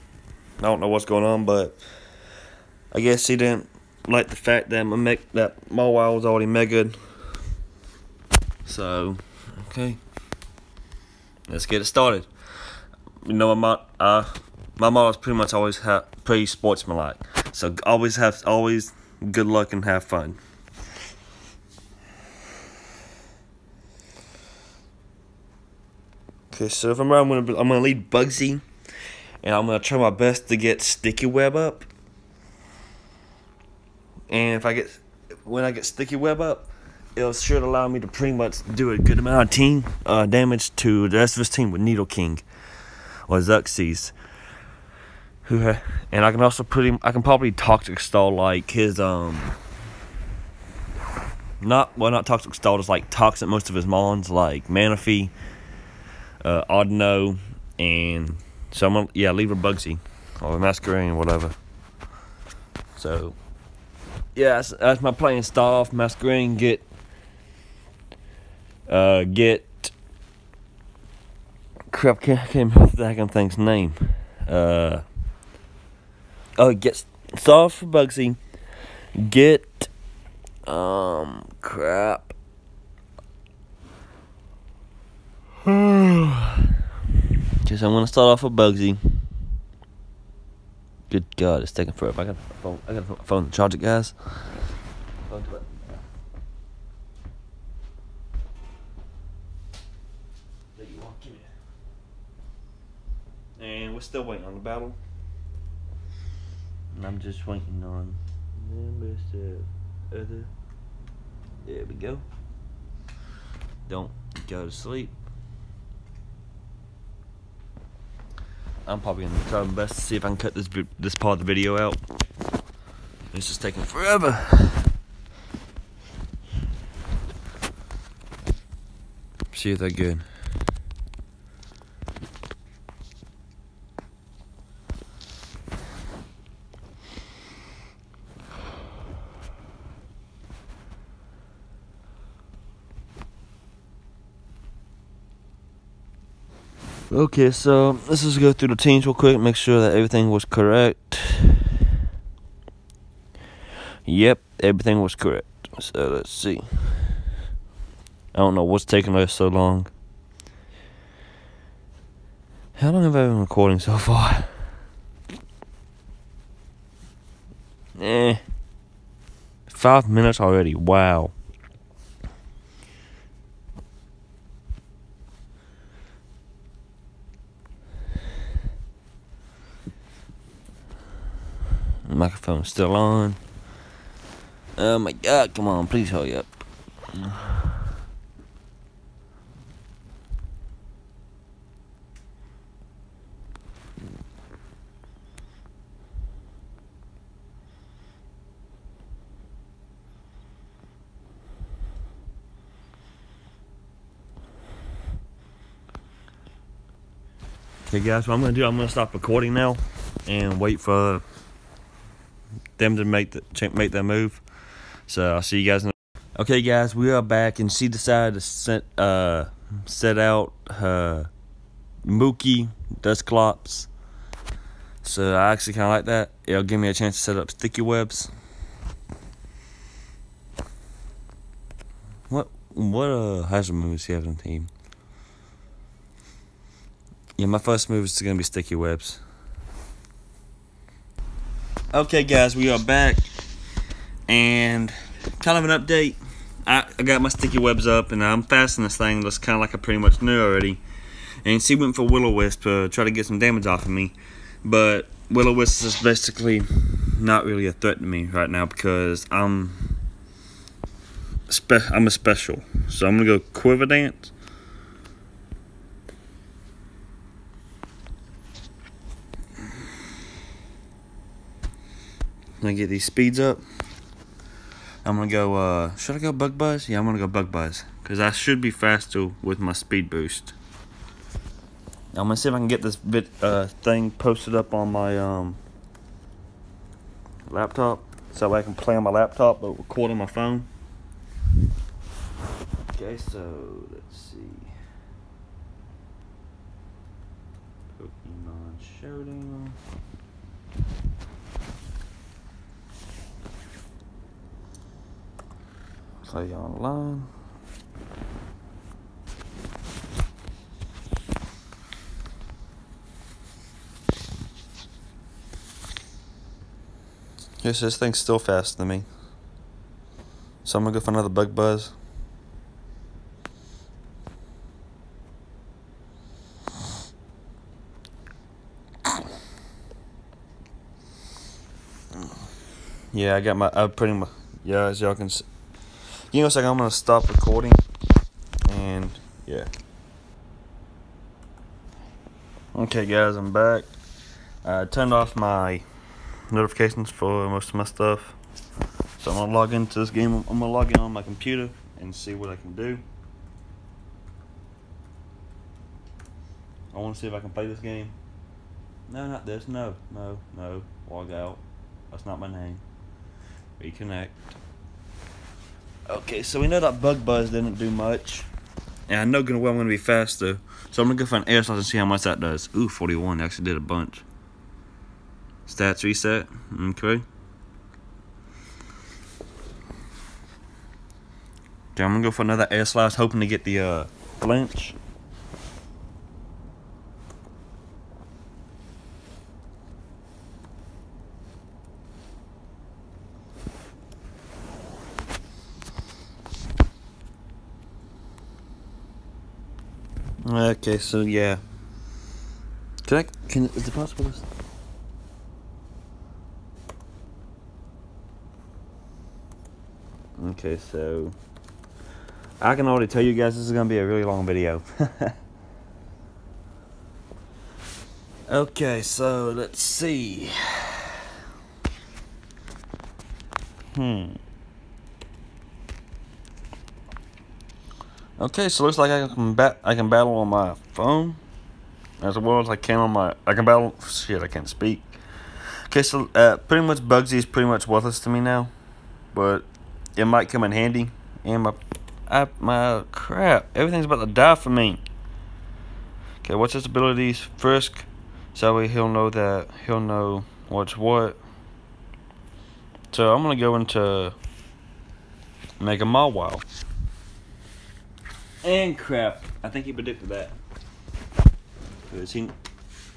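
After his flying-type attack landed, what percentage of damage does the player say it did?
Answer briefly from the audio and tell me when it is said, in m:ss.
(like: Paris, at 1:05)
41, at 6:12.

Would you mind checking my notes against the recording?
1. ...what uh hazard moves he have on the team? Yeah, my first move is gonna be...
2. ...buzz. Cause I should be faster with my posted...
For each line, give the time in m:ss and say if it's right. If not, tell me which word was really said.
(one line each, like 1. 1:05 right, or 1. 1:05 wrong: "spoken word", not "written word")
1. 3:52 right
2. 4:37 wrong: "speed", not "posted".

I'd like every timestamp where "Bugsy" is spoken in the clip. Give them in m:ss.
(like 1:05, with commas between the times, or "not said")
0:28, 0:59, 1:17, 1:28, 7:16.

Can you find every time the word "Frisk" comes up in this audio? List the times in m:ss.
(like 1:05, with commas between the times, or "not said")
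7:27.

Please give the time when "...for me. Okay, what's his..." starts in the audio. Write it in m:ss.
7:24.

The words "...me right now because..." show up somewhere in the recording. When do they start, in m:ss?
4:18.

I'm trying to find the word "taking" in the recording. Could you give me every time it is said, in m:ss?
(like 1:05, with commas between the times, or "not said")
1:31, 2:03, 2:38.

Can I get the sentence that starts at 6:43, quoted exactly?
Can I, can, is it possible to...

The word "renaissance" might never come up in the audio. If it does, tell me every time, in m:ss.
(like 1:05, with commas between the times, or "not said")
not said.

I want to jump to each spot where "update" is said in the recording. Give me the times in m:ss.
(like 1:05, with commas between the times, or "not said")
4:05.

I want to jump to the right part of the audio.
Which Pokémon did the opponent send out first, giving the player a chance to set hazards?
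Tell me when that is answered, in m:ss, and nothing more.
3:43.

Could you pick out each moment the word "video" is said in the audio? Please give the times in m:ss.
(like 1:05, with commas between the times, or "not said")
2:01, 6:54.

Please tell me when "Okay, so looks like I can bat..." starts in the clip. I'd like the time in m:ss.
7:08.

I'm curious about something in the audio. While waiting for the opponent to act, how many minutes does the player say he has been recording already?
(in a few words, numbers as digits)
5.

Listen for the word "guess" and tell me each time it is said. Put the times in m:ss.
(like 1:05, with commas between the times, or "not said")
0:03.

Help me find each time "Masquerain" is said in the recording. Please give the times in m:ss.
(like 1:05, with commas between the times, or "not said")
1:00, 1:05.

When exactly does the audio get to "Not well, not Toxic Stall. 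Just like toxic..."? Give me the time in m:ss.
0:51.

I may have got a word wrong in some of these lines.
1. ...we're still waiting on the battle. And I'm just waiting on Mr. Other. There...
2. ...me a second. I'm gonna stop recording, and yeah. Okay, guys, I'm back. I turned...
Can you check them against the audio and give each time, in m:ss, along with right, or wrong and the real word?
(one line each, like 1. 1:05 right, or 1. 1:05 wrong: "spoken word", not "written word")
1. 1:43 right
2. 5:36 right.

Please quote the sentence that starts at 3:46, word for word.
It'll give me a chance to set up sticky webs.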